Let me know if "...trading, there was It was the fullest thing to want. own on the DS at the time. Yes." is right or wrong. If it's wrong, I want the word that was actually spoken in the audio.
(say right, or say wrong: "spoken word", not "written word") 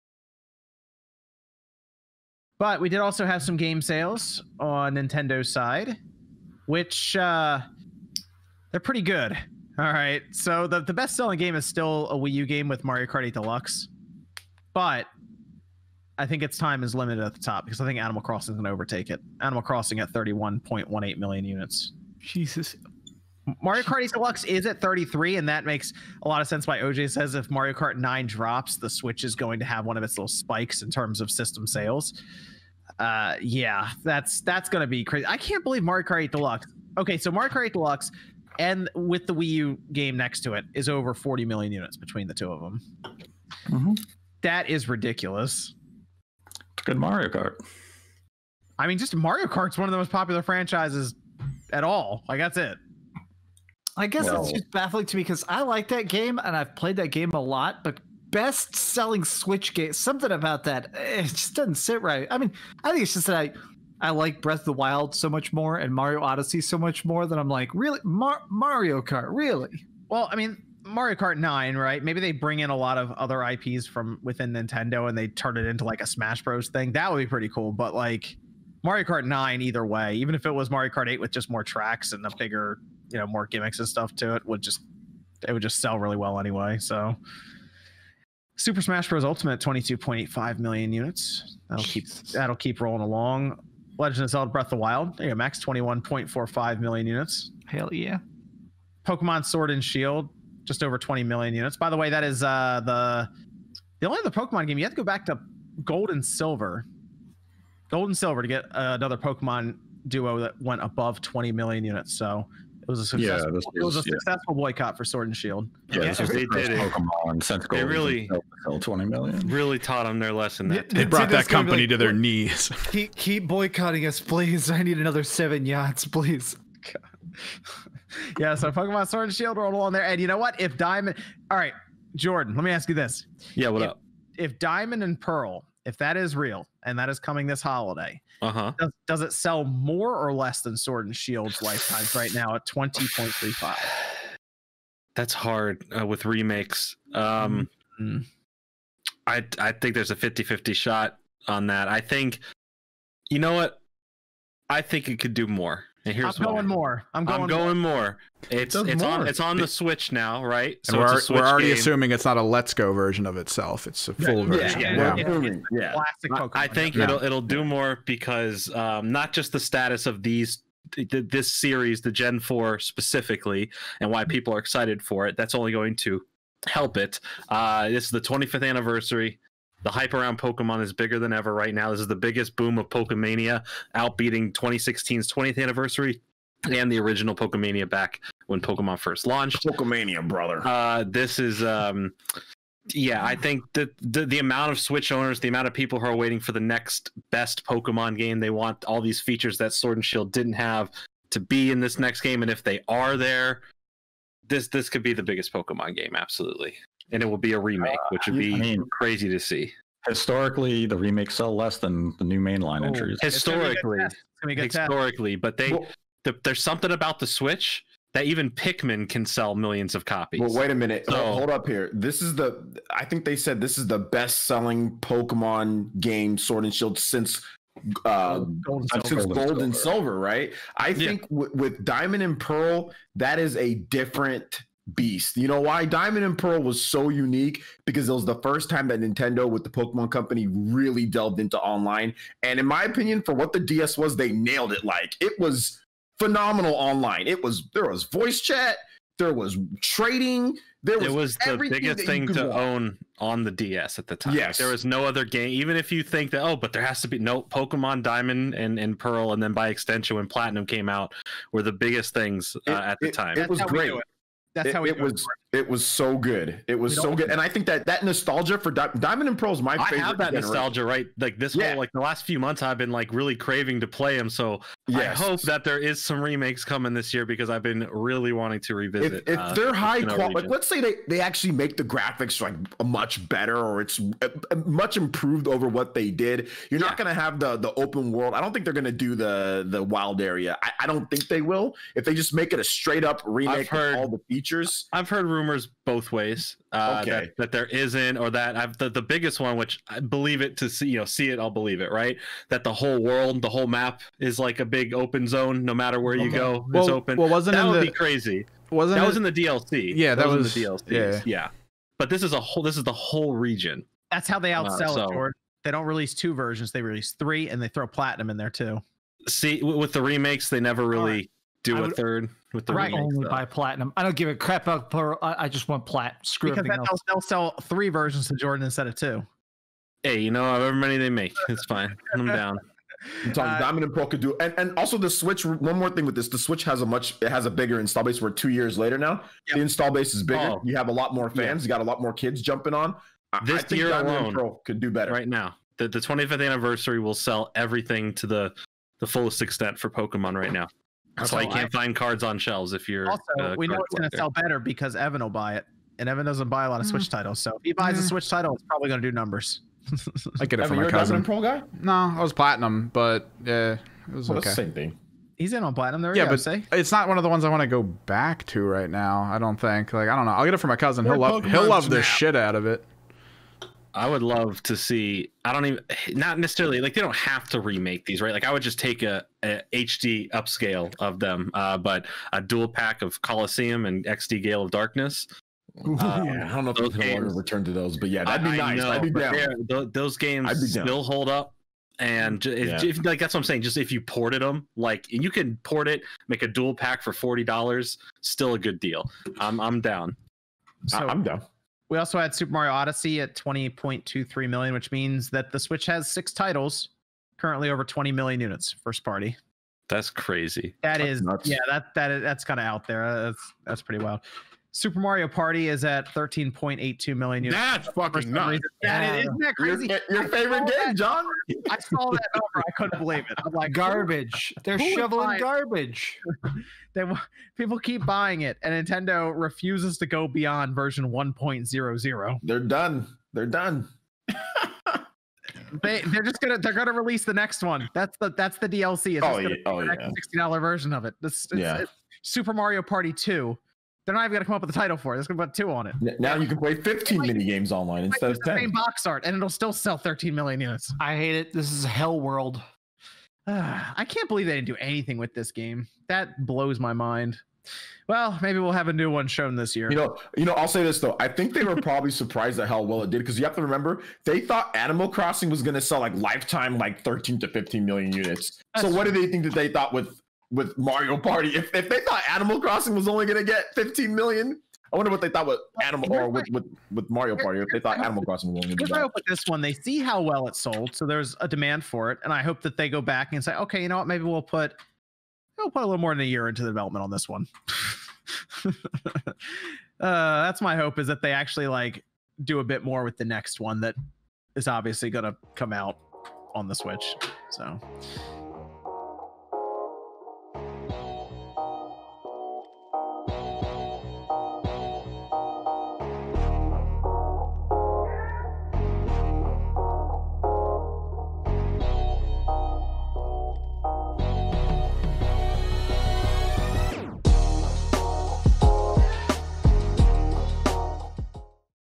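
wrong: "biggest", not "fullest".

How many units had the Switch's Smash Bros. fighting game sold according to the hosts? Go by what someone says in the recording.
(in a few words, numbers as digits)
22.85 million units.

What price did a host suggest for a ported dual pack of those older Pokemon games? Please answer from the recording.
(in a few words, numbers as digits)
$40.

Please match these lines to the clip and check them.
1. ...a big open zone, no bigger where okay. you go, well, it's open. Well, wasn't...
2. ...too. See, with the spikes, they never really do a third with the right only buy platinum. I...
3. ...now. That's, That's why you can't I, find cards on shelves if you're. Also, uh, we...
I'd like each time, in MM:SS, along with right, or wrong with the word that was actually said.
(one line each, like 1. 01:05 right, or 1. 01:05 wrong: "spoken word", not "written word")
1. 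05:04 wrong: "matter", not "bigger"
2. 05:18 wrong: "remakes", not "spikes"
3. 05:50 right.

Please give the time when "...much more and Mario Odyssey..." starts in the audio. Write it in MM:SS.
01:05.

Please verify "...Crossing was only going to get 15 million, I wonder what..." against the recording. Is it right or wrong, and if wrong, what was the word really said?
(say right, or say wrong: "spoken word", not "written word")
right.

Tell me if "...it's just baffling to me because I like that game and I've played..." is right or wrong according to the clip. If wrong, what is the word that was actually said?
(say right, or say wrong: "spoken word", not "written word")
right.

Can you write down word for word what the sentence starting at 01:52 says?
So it was a successful, yeah, it was a successful boycott for Sword and Shield.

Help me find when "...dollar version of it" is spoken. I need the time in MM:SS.
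07:20.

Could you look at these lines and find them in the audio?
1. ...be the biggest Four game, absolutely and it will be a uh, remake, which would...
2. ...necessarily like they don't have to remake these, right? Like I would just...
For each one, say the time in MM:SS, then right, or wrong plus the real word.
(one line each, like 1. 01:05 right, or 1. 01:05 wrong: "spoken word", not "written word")
1. 03:25 wrong: "Pokemon", not "Four"
2. 06:16 right.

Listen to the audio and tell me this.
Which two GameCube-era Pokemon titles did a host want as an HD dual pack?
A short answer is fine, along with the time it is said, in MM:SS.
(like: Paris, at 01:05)
Colosseum and XD Gale of Darkness, at 06:23.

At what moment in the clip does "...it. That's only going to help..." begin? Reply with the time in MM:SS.
02:55.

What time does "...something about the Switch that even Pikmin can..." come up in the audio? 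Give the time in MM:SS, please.
03:36.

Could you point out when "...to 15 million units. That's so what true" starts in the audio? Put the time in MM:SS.
07:47.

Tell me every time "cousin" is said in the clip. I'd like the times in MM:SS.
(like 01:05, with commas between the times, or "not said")
06:00, 06:10.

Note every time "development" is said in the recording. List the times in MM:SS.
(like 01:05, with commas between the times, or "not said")
08:06.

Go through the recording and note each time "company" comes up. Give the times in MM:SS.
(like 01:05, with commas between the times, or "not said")
02:01, 04:00.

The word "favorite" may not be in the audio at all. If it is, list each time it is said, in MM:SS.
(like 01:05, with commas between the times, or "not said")
04:29, 07:00.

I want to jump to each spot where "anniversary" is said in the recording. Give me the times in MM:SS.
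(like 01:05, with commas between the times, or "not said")
02:58, 03:05, 05:46.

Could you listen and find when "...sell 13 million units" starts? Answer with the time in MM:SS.
07:29.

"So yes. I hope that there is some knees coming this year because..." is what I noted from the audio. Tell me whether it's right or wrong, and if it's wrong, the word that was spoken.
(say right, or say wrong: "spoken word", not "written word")
wrong: "remakes", not "knees".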